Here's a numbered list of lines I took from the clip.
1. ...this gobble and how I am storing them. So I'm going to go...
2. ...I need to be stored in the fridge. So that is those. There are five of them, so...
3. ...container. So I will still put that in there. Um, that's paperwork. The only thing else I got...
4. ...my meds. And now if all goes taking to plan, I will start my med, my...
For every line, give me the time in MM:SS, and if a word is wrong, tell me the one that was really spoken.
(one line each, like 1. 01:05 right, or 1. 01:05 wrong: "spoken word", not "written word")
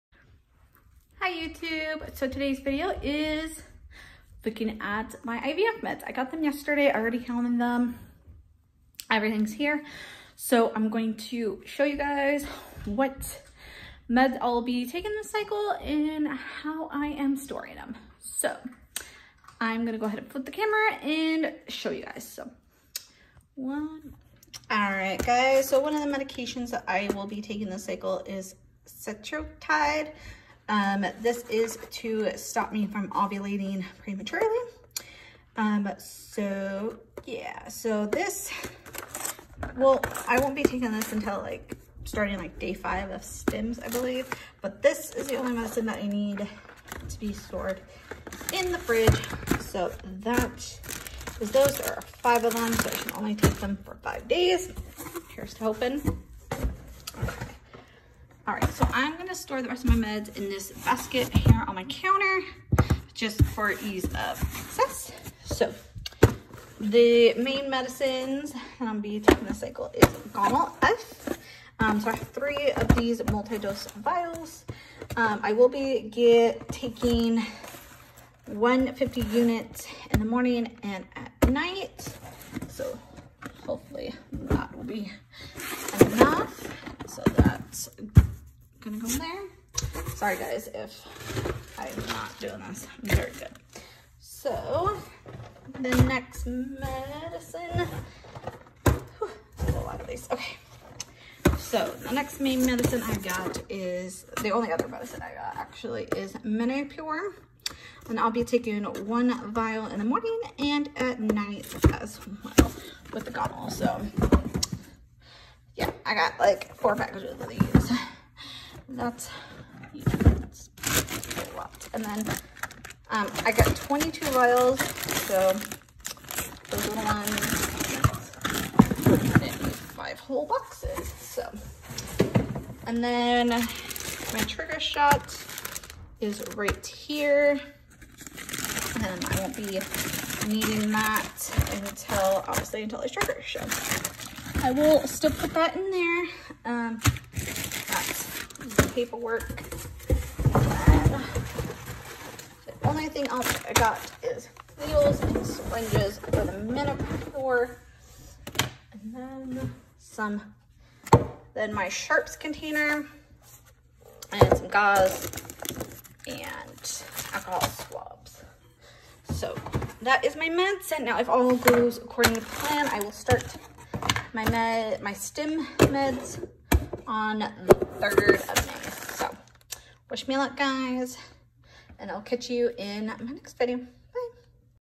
1. 00:15 wrong: "cycle", not "gobble"
2. 00:45 right
3. 02:23 wrong: "trigger", not "container"
4. 02:50 wrong: "according", not "taking".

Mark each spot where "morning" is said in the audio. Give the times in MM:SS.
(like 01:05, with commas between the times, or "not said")
01:20, 01:50.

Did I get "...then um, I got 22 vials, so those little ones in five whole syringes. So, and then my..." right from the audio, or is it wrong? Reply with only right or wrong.
wrong.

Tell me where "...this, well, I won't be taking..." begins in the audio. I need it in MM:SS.
00:38.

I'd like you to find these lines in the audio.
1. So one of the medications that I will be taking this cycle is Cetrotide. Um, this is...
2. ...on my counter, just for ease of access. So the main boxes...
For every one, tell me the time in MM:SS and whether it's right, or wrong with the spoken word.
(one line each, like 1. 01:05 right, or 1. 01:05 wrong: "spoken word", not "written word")
1. 00:25 right
2. 01:01 wrong: "medicines", not "boxes".